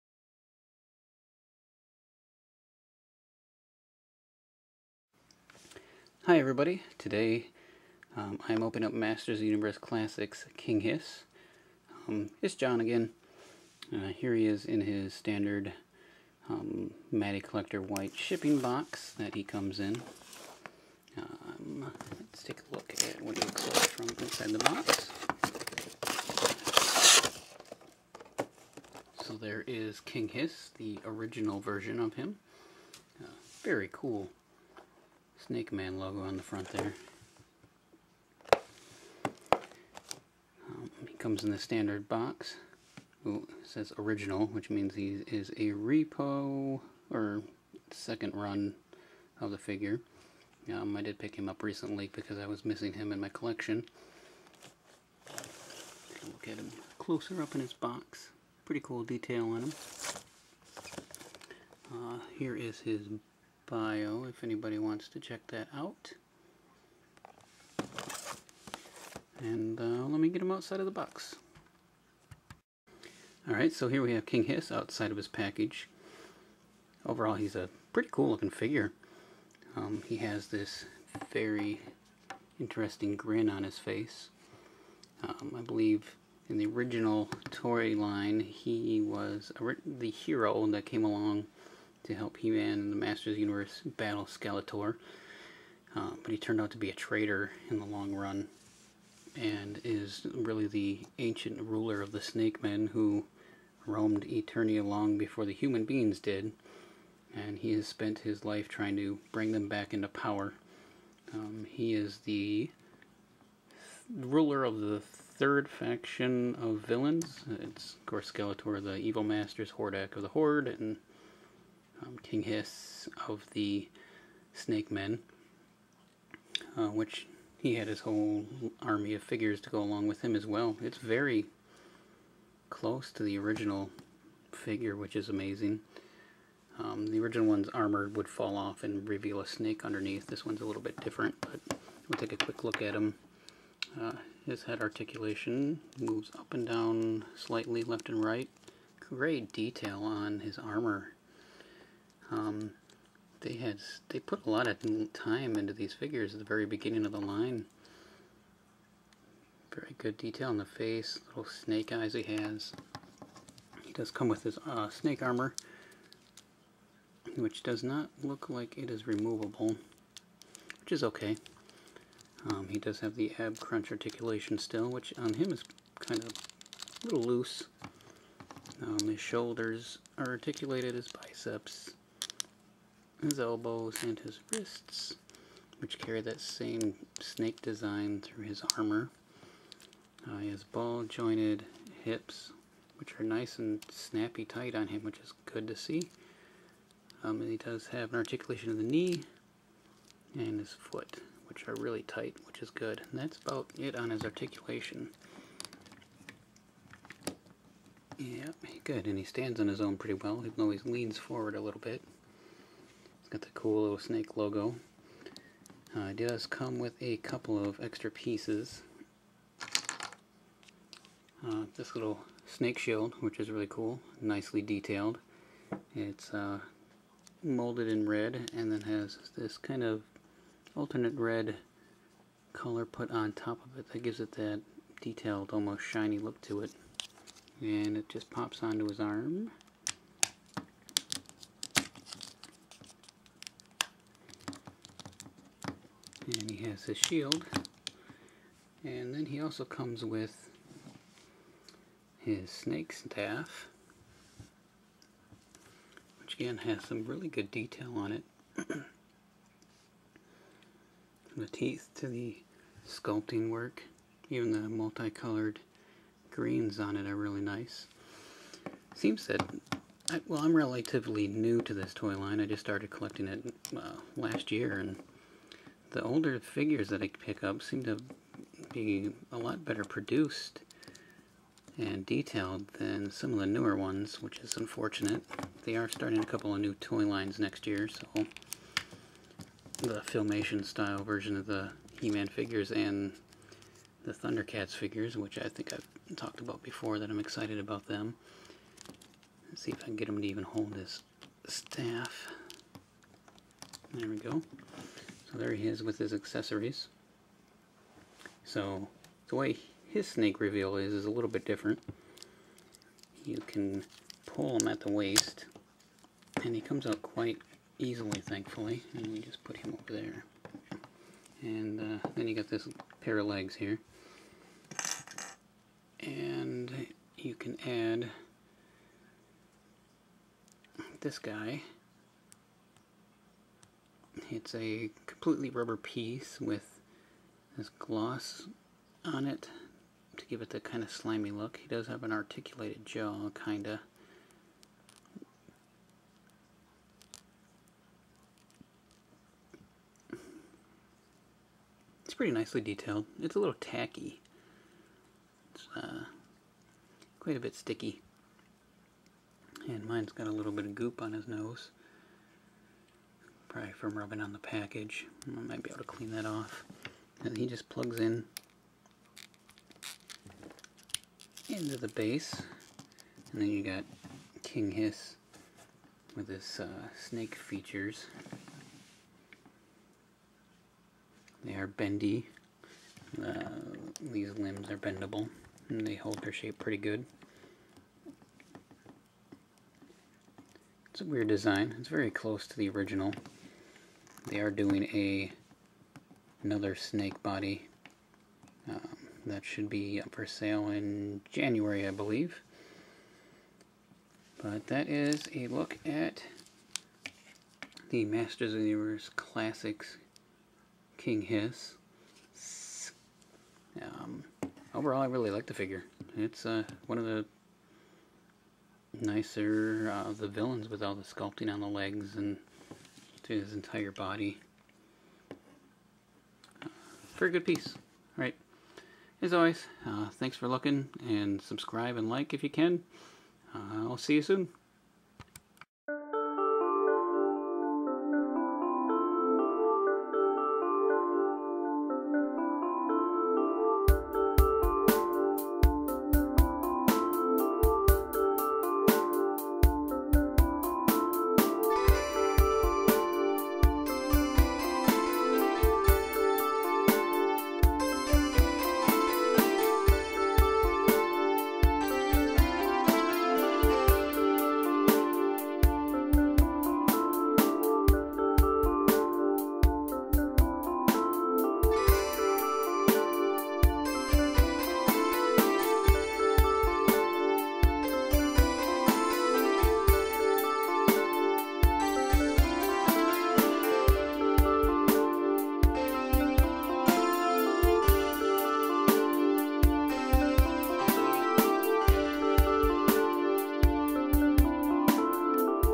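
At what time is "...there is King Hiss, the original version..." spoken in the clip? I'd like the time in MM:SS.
00:29.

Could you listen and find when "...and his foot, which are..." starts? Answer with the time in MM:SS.
03:20.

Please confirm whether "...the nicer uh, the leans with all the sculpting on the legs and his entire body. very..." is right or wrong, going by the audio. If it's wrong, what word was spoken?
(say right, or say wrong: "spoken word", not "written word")
wrong: "villains", not "leans".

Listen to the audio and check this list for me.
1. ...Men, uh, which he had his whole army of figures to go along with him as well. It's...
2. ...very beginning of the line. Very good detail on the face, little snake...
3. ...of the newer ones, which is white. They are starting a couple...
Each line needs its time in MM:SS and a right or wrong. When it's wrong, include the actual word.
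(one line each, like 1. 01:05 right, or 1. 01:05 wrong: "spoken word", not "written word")
1. 02:04 right
2. 02:36 right
3. 04:43 wrong: "unfortunate", not "white".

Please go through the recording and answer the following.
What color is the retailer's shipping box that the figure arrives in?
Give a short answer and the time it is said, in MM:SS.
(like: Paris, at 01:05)
White, at 00:17.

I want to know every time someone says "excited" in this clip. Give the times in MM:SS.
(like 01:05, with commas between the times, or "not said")
04:57.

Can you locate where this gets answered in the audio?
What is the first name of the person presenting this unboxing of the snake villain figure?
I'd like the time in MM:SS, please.
00:12.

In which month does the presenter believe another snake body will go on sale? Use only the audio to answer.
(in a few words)
January.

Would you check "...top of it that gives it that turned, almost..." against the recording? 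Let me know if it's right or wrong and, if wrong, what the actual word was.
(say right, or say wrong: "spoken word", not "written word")
wrong: "detailed", not "turned".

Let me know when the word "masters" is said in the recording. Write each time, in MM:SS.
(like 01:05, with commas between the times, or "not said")
00:08, 01:32, 01:59, 06:48.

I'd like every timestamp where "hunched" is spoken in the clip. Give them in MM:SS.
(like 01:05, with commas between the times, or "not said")
not said.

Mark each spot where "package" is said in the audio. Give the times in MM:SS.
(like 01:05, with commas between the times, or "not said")
01:15, 06:04.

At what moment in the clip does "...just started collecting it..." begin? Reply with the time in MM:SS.
04:32.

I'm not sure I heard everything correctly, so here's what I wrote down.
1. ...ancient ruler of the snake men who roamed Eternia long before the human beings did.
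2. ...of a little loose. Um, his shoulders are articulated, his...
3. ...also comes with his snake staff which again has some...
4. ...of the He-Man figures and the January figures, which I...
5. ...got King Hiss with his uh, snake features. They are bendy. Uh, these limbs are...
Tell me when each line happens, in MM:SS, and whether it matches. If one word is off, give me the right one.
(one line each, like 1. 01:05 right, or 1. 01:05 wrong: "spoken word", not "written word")
1. 01:41 right
2. 02:56 right
3. 04:09 right
4. 04:51 wrong: "Thundercats", not "January"
5. 06:13 right.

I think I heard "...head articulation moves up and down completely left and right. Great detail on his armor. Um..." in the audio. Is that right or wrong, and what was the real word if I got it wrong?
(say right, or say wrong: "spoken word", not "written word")
wrong: "slightly", not "completely".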